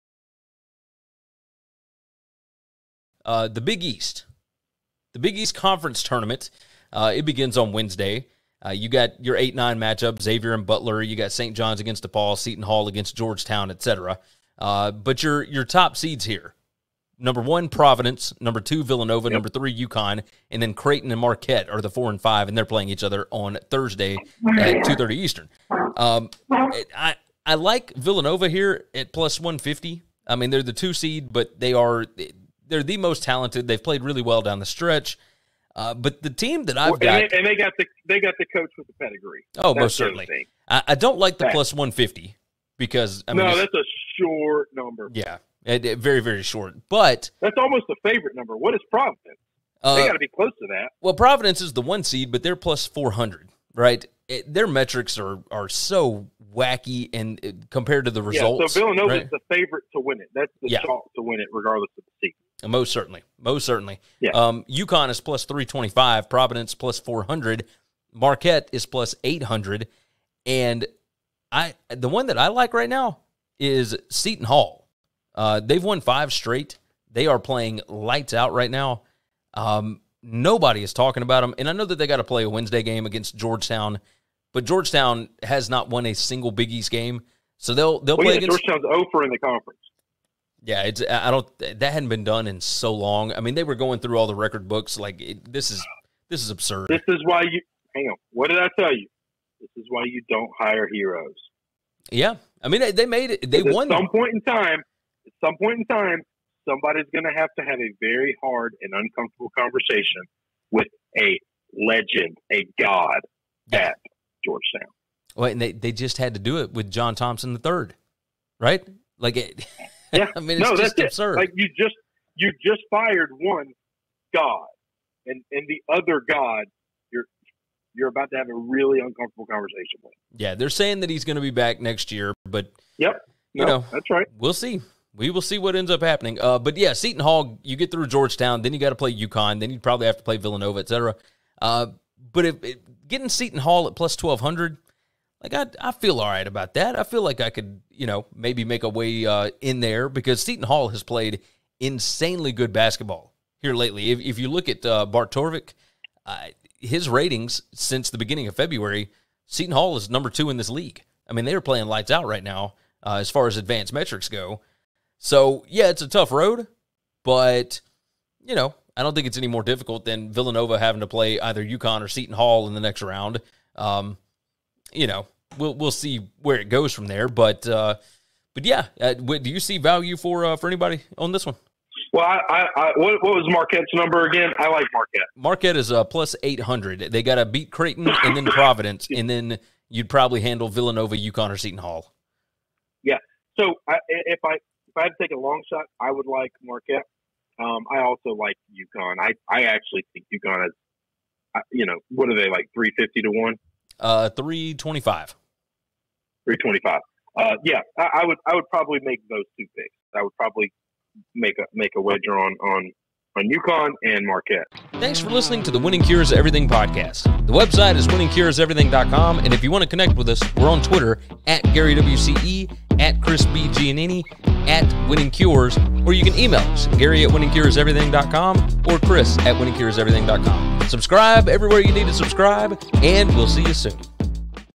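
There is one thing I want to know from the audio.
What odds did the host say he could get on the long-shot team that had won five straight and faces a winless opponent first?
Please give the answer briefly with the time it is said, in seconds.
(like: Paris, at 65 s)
+1200, at 143 s.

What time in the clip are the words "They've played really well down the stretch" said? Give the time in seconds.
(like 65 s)
33 s.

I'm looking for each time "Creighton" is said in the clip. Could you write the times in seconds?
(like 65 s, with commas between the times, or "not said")
20 s, 187 s.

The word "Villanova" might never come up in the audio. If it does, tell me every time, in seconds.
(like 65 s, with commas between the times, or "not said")
18 s, 27 s, 58 s, 140 s, 170 s, 190 s.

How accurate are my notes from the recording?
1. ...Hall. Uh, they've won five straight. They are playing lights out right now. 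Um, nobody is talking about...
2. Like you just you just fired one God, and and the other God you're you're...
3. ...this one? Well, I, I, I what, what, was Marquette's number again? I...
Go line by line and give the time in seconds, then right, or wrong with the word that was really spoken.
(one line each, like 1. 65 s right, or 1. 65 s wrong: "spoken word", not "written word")
1. 74 s right
2. 121 s right
3. 181 s right.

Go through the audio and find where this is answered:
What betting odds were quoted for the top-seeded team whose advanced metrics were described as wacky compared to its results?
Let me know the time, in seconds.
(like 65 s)
52 s.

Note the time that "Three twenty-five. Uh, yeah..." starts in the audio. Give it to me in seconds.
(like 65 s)
206 s.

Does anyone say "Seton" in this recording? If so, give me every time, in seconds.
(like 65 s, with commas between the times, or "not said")
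12 s, 74 s, 136 s, 143 s, 150 s, 159 s, 172 s, 191 s.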